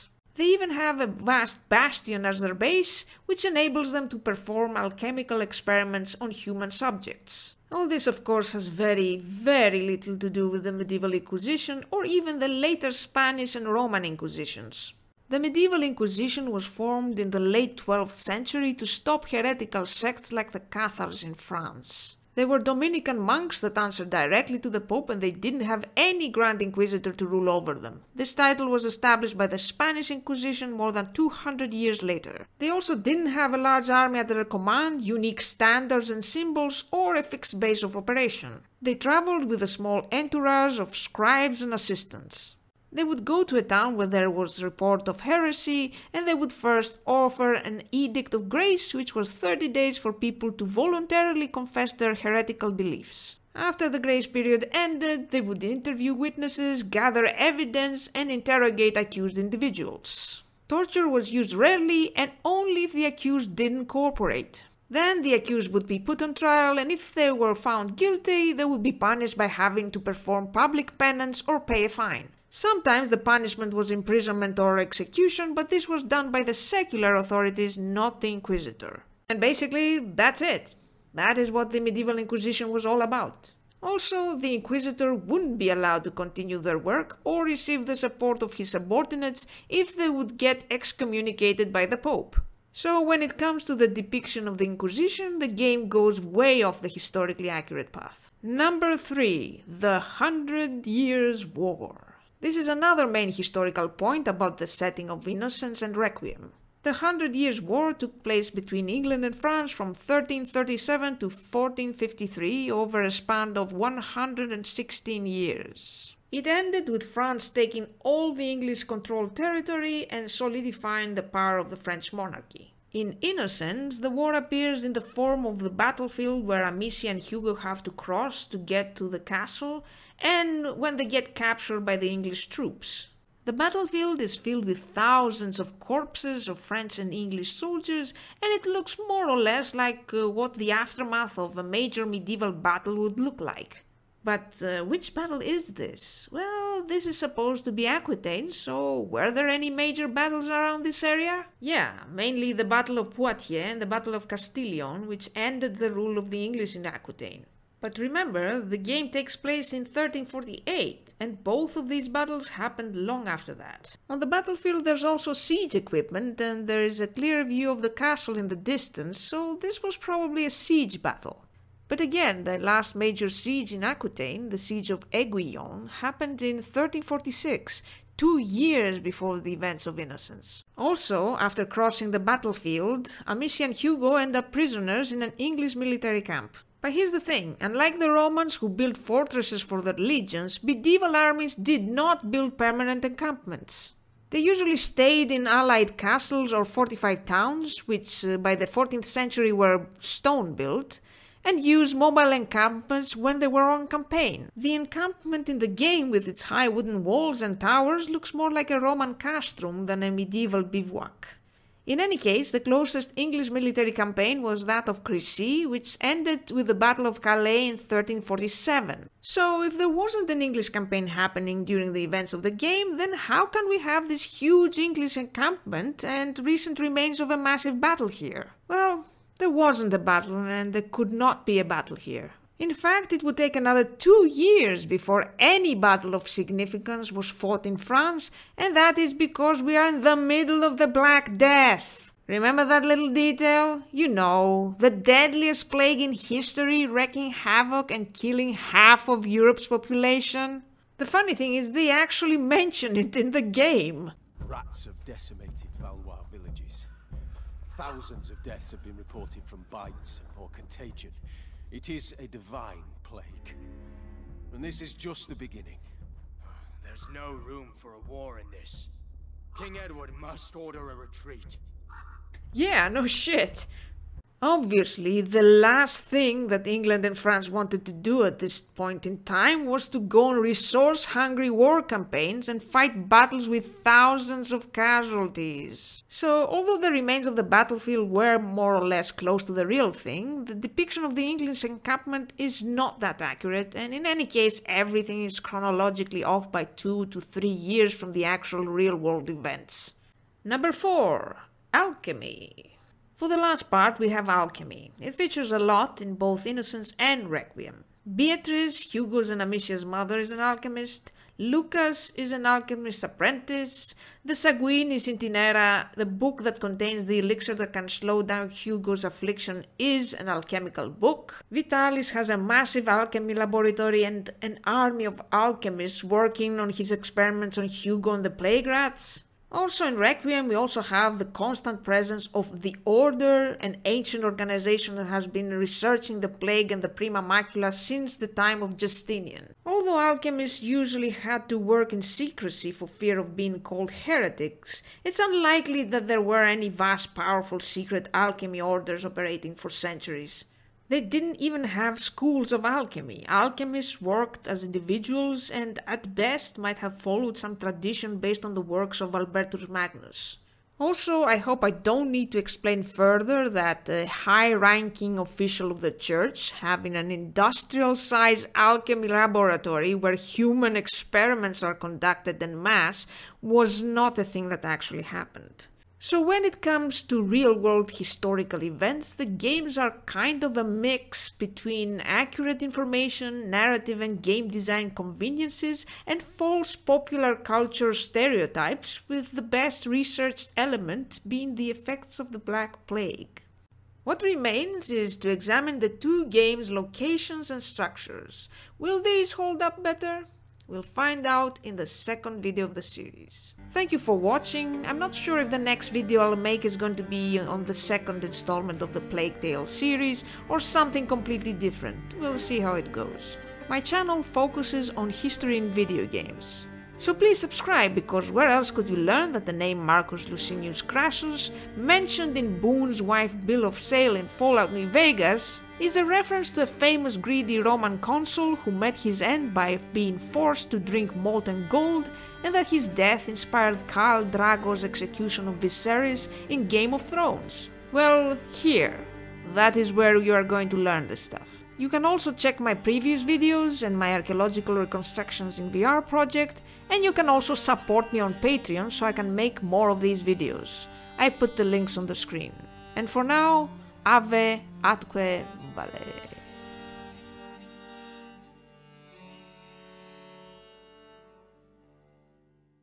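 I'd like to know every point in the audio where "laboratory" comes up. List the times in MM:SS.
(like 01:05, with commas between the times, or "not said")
05:23, 06:09.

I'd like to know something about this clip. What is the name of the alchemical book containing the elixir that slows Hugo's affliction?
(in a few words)
Sanguinis Itinera.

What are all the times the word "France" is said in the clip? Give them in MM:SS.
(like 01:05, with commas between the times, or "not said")
00:21, 01:49, 01:57, 03:57, 04:37.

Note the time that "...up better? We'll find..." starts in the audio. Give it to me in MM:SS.
06:39.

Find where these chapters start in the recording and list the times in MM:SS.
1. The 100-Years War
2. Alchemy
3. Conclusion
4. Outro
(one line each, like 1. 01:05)
1. 01:37
2. 04:59
3. 06:14
4. 06:42.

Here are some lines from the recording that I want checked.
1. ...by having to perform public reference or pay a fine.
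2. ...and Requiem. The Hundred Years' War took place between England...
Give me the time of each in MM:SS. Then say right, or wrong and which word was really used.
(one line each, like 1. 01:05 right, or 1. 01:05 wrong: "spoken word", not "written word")
1. 01:09 wrong: "penance", not "reference"
2. 01:45 right.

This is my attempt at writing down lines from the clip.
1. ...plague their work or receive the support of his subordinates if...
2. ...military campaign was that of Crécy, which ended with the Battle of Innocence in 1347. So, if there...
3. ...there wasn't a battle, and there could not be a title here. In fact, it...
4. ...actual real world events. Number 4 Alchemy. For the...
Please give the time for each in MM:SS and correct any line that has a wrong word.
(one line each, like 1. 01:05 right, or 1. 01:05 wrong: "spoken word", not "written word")
1. 01:26 wrong: "continue", not "plague"
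2. 03:33 wrong: "Calais", not "Innocence"
3. 03:49 wrong: "battle", not "title"
4. 04:58 right.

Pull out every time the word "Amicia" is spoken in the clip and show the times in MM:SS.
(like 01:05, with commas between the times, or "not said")
02:06, 03:03, 05:09.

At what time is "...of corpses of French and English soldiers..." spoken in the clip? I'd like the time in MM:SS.
02:15.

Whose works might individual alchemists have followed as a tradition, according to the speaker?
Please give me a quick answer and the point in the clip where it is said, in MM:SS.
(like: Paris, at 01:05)
Albertus Magnus, at 05:59.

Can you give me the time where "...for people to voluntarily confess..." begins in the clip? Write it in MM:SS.
00:49.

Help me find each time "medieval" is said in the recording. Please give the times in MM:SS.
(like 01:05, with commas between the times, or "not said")
00:10, 00:15, 01:21, 02:22, 03:10, 03:30.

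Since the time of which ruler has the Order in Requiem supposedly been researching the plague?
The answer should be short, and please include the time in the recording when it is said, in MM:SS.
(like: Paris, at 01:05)
Justinian, at 05:38.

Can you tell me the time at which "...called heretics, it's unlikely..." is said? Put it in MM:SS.
05:43.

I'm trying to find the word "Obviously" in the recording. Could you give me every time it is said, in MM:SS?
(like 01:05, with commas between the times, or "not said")
04:34.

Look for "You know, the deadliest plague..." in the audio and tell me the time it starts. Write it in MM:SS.
04:03.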